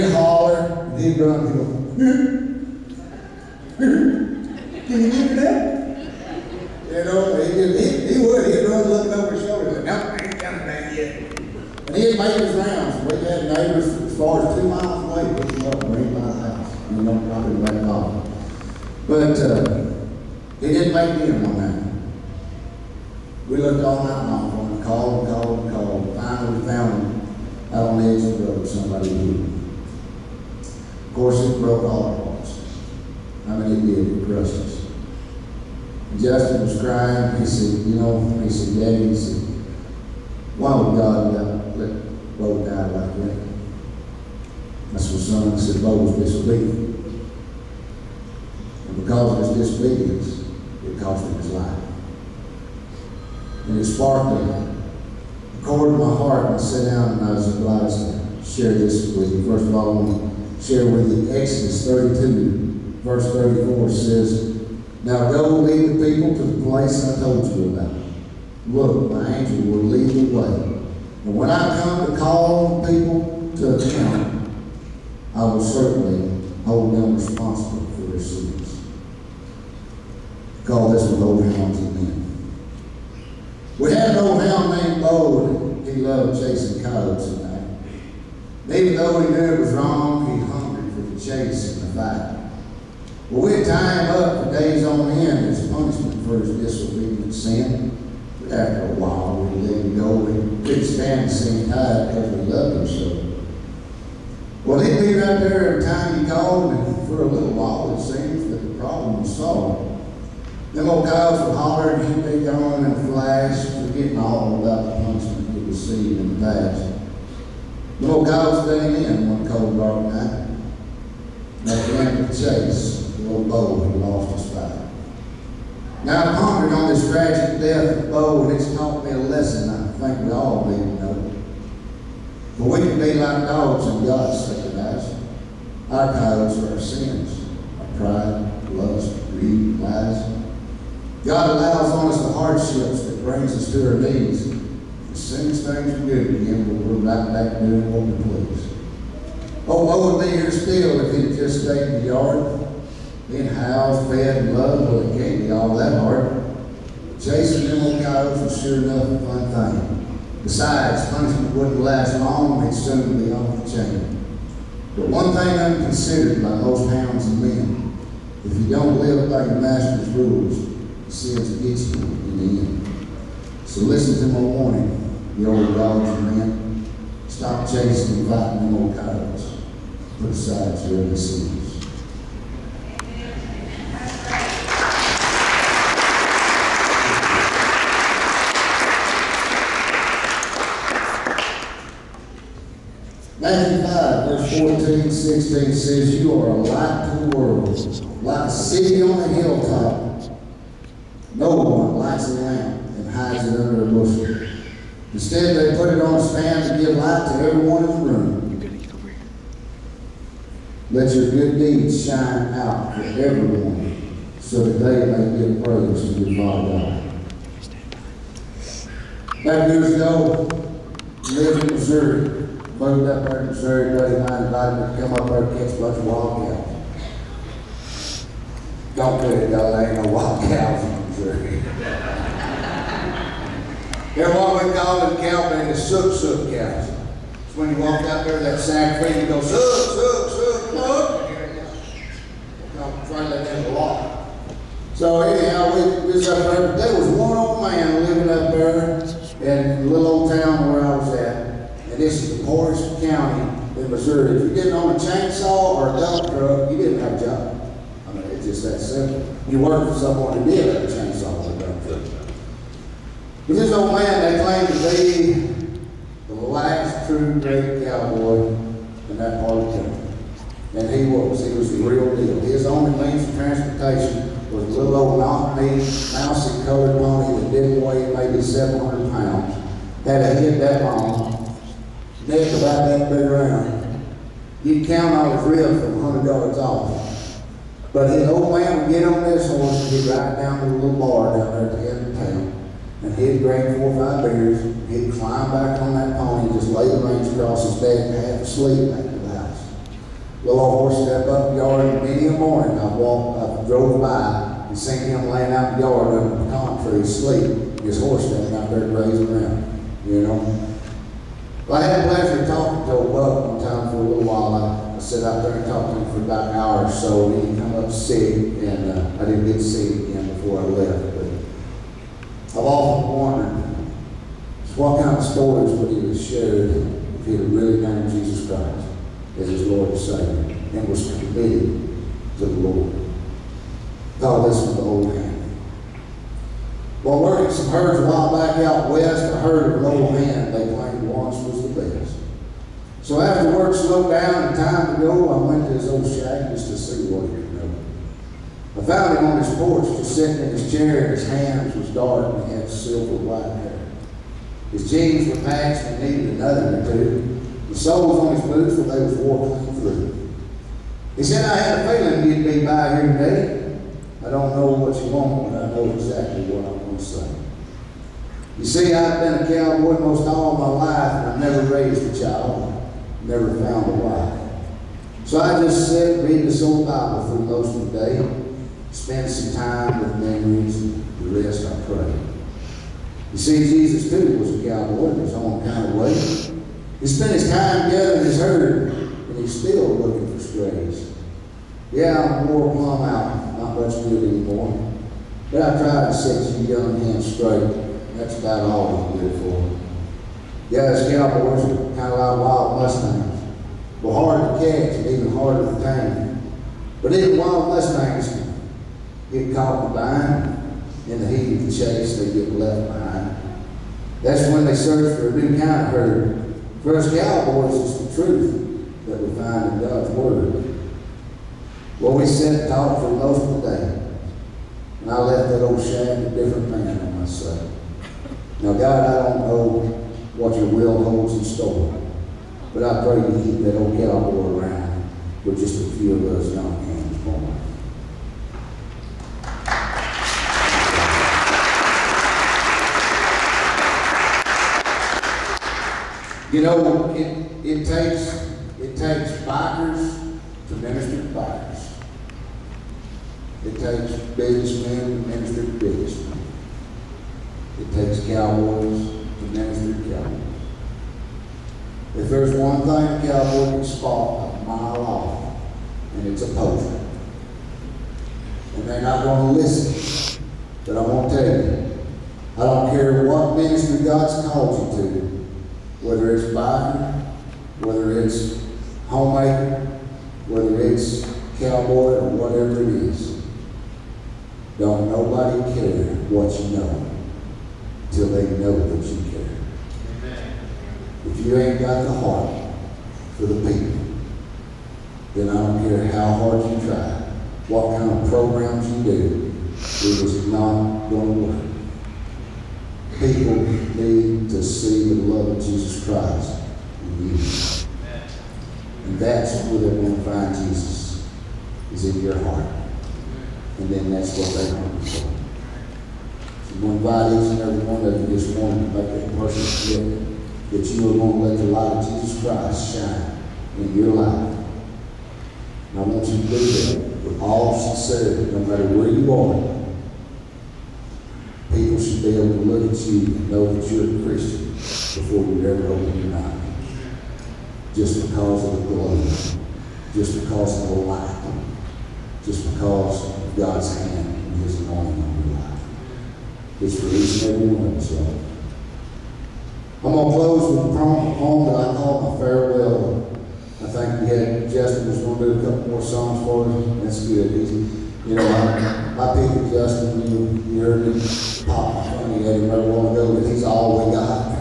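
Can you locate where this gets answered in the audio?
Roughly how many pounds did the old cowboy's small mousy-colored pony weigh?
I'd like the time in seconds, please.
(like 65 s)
278 s.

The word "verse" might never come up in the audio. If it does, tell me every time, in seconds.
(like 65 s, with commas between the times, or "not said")
63 s, 194 s.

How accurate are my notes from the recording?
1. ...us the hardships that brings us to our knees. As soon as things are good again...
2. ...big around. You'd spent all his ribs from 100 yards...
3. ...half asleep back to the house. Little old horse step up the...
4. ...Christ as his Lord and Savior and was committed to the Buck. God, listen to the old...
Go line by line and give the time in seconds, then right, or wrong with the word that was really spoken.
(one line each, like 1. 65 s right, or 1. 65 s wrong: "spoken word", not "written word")
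1. 142 s right
2. 283 s wrong: "count", not "spent"
3. 298 s right
4. 328 s wrong: "Lord", not "Buck".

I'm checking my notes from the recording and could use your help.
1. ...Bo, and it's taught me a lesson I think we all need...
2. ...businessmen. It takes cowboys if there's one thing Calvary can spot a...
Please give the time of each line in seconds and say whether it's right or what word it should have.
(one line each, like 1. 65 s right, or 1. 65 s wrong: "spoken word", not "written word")
1. 128 s right
2. 455 s right.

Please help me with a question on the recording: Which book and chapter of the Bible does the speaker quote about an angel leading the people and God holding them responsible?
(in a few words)
Exodus 32.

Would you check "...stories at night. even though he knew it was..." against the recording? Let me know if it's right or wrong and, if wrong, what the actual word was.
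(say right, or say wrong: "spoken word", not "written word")
wrong: "coyotes", not "stories".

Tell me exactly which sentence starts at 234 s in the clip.
They're what we call in cowband the sook sook cows.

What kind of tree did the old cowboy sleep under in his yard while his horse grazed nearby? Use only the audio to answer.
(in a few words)
pecan tree.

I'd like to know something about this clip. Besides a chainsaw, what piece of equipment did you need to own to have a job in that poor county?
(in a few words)
dump truck.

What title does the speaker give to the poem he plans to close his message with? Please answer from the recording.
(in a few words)
My farewell.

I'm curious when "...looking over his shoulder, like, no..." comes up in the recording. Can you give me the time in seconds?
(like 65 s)
8 s.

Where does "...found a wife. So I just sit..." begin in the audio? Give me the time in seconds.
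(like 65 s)
373 s.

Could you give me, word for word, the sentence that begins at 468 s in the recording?
And they're not going to listen.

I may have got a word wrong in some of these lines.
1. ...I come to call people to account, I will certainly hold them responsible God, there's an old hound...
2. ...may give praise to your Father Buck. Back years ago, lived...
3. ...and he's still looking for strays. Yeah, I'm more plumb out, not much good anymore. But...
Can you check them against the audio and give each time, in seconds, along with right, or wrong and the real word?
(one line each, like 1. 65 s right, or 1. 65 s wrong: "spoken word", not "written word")
1. 71 s right
2. 215 s wrong: "God", not "Buck"
3. 388 s right.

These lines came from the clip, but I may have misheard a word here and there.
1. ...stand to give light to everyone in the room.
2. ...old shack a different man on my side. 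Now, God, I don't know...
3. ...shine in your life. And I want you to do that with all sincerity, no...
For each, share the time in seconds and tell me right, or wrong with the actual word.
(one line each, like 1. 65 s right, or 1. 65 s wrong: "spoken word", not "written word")
1. 206 s right
2. 425 s right
3. 522 s right.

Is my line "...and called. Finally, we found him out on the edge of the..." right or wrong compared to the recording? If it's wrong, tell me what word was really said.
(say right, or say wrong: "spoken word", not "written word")
right.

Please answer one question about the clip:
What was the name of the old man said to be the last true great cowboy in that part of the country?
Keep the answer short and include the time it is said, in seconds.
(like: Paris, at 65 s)
Buck, at 313 s.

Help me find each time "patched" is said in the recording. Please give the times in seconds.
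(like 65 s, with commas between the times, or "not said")
355 s.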